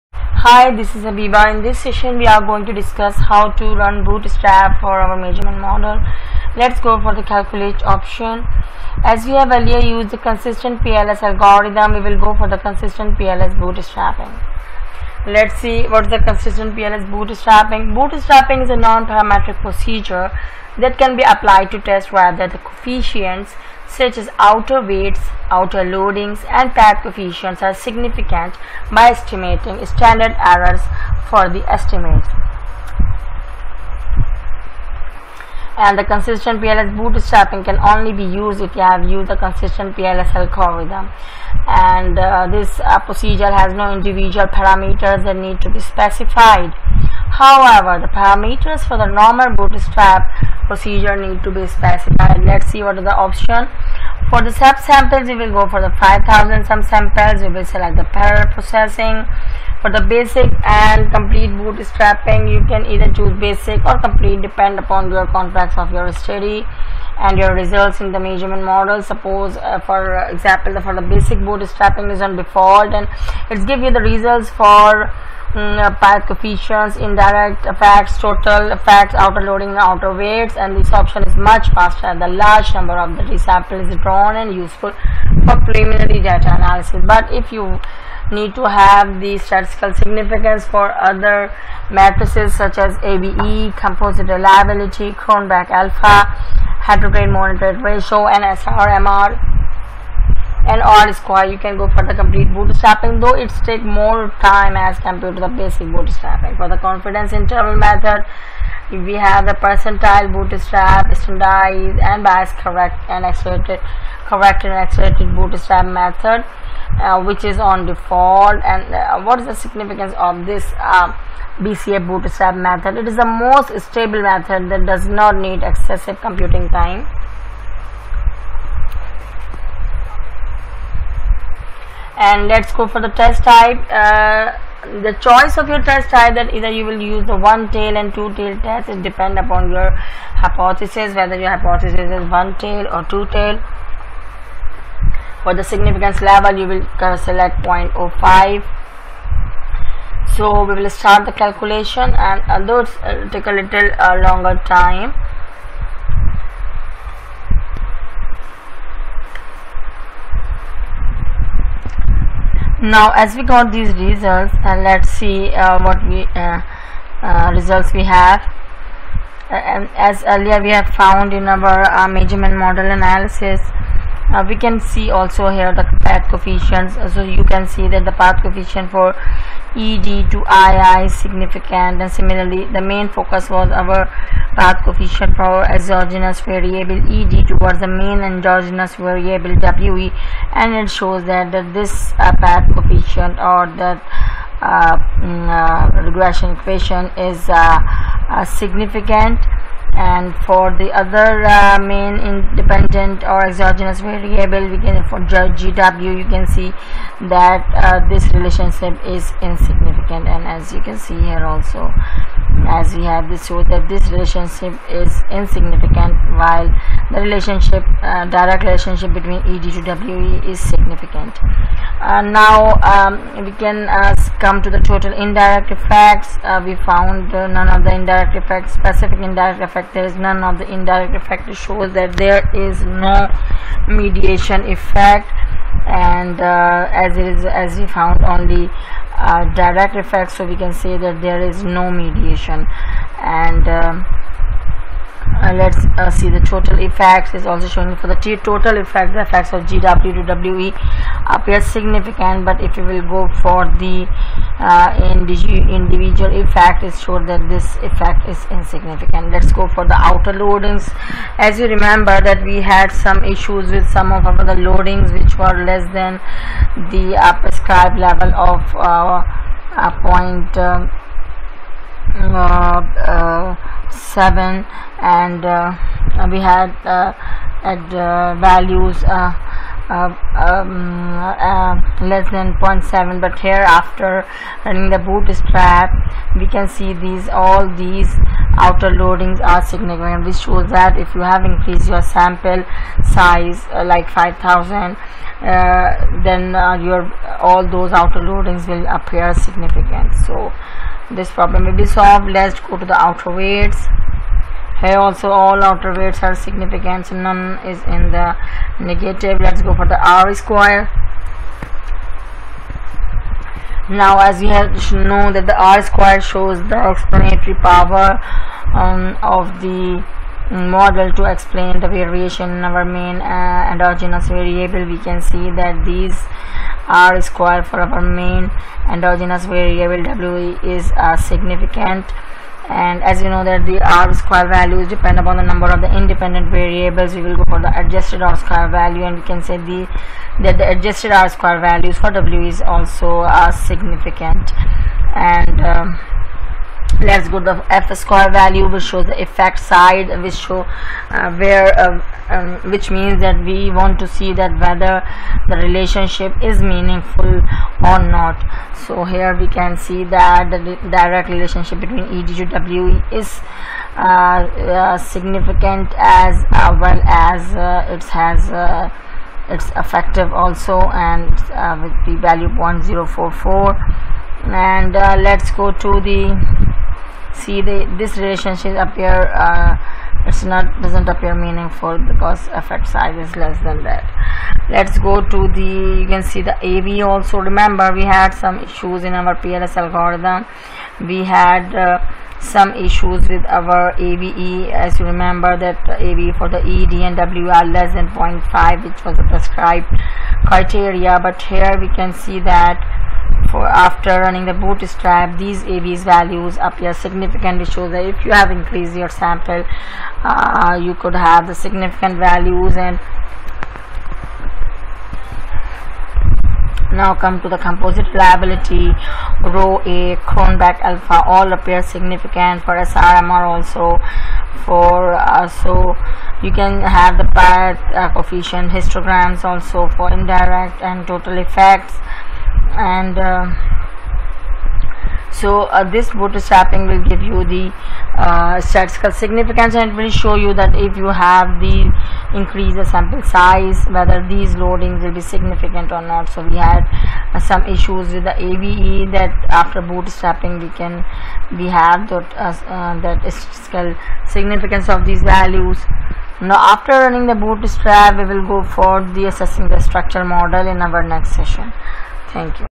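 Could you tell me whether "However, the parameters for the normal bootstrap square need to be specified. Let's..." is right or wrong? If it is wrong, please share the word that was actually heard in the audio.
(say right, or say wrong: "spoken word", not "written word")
wrong: "procedure", not "square".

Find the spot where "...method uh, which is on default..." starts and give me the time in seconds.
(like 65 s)
115 s.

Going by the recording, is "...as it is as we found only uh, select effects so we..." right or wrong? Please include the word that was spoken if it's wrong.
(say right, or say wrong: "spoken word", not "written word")
wrong: "direct", not "select".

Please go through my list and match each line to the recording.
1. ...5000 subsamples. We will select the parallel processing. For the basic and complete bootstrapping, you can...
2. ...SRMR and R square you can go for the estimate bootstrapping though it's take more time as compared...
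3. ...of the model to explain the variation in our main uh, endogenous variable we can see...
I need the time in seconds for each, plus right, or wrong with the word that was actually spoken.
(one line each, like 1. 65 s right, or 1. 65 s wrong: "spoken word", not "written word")
1. 55 s right
2. 98 s wrong: "complete", not "estimate"
3. 319 s right.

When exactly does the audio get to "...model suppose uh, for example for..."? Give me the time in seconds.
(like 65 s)
68 s.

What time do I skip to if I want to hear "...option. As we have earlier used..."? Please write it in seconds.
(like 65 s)
7 s.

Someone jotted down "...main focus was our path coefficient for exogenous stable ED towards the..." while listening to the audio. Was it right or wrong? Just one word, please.
wrong.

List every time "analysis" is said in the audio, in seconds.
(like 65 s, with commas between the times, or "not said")
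86 s, 172 s.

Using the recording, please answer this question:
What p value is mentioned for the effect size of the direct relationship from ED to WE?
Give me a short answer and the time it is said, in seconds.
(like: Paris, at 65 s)
0.044, at 372 s.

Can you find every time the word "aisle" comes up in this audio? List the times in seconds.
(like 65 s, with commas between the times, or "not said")
not said.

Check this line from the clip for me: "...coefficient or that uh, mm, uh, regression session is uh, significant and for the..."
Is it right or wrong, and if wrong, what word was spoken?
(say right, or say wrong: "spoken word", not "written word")
wrong: "equation", not "session".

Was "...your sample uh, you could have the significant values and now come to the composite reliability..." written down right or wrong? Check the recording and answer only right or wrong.
right.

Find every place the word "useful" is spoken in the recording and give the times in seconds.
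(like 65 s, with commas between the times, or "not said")
84 s.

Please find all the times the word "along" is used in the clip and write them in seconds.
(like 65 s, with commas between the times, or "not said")
not said.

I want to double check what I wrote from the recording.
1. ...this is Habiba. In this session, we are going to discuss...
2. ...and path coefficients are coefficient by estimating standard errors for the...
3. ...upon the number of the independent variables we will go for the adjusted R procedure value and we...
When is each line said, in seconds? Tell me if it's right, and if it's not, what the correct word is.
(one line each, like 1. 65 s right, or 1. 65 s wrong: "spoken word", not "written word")
1. 0 s right
2. 26 s wrong: "significant", not "coefficient"
3. 335 s wrong: "square", not "procedure".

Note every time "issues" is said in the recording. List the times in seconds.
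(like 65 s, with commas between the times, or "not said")
263 s, 388 s, 392 s, 447 s.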